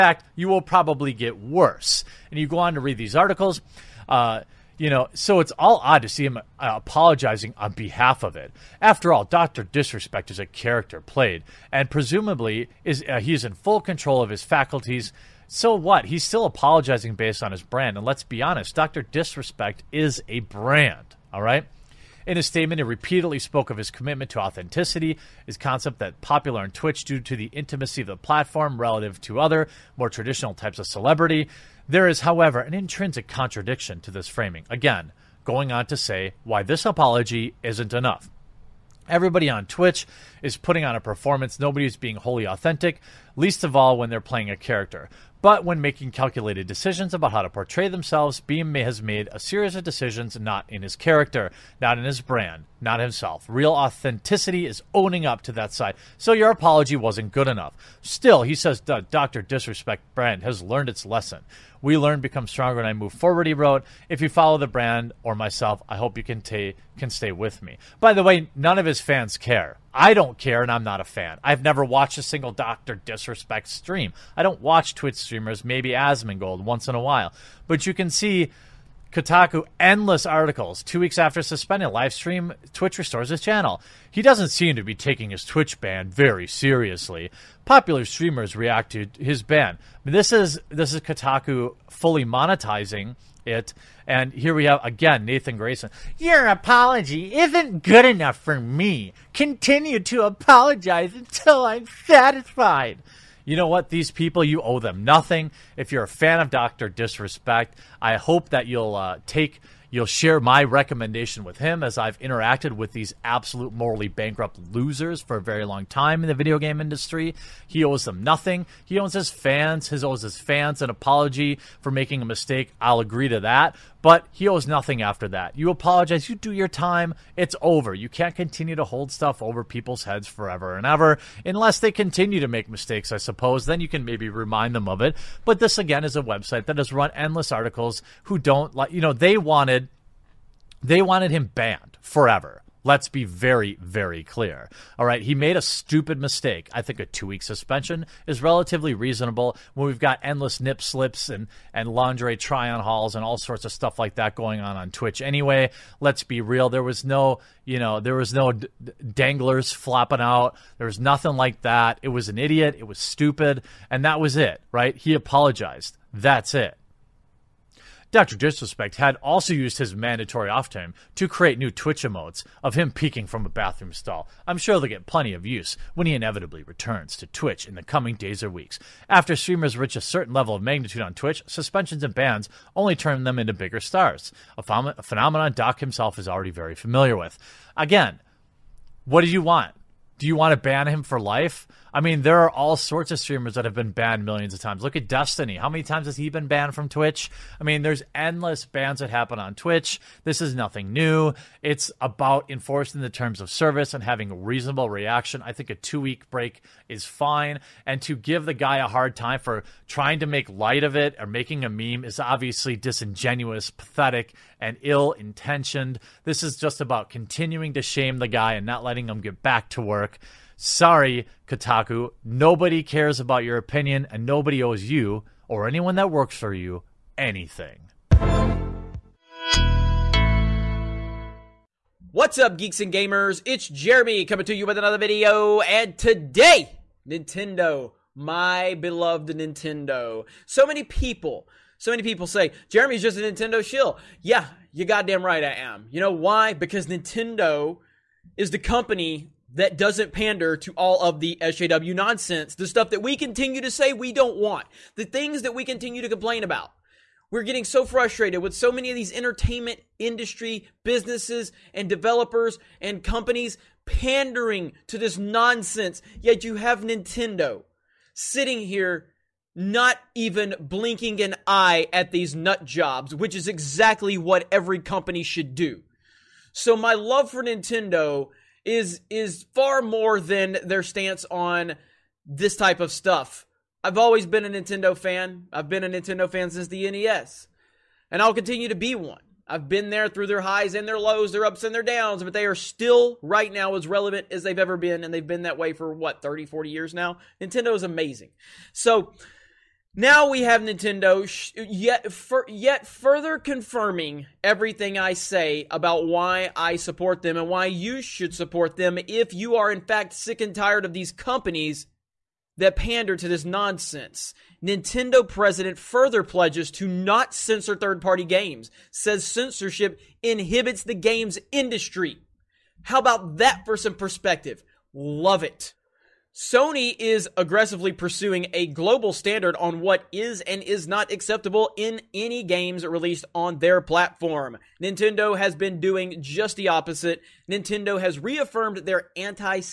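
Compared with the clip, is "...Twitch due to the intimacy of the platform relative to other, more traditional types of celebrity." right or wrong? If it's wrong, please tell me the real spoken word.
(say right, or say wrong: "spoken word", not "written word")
right.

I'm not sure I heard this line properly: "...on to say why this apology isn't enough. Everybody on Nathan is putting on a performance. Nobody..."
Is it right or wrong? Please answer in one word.
wrong.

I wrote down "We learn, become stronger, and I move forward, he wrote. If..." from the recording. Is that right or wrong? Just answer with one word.
right.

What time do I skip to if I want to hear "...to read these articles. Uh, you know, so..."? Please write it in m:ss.
0:02.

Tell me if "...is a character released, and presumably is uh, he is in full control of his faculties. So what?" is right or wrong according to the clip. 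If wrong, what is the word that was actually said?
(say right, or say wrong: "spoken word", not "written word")
wrong: "played", not "released".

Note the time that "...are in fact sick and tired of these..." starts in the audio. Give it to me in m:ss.
5:09.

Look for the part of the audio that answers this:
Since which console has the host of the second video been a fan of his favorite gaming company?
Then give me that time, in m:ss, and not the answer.
4:46.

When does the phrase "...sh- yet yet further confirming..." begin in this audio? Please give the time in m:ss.
5:01.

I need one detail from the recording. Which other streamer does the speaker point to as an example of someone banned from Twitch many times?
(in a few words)
Destiny.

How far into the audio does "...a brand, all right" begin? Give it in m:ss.
0:20.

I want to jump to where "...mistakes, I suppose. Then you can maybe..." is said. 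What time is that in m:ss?
2:12.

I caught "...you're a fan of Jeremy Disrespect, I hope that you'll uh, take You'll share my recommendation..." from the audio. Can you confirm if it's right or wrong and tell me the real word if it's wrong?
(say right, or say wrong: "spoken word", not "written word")
wrong: "Doctor", not "Jeremy".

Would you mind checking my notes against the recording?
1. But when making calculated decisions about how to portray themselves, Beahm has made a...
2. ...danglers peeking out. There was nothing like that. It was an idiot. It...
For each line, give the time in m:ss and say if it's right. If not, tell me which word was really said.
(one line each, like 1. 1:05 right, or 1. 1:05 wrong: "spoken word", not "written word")
1. 0:45 right
2. 2:39 wrong: "flopping", not "peeking".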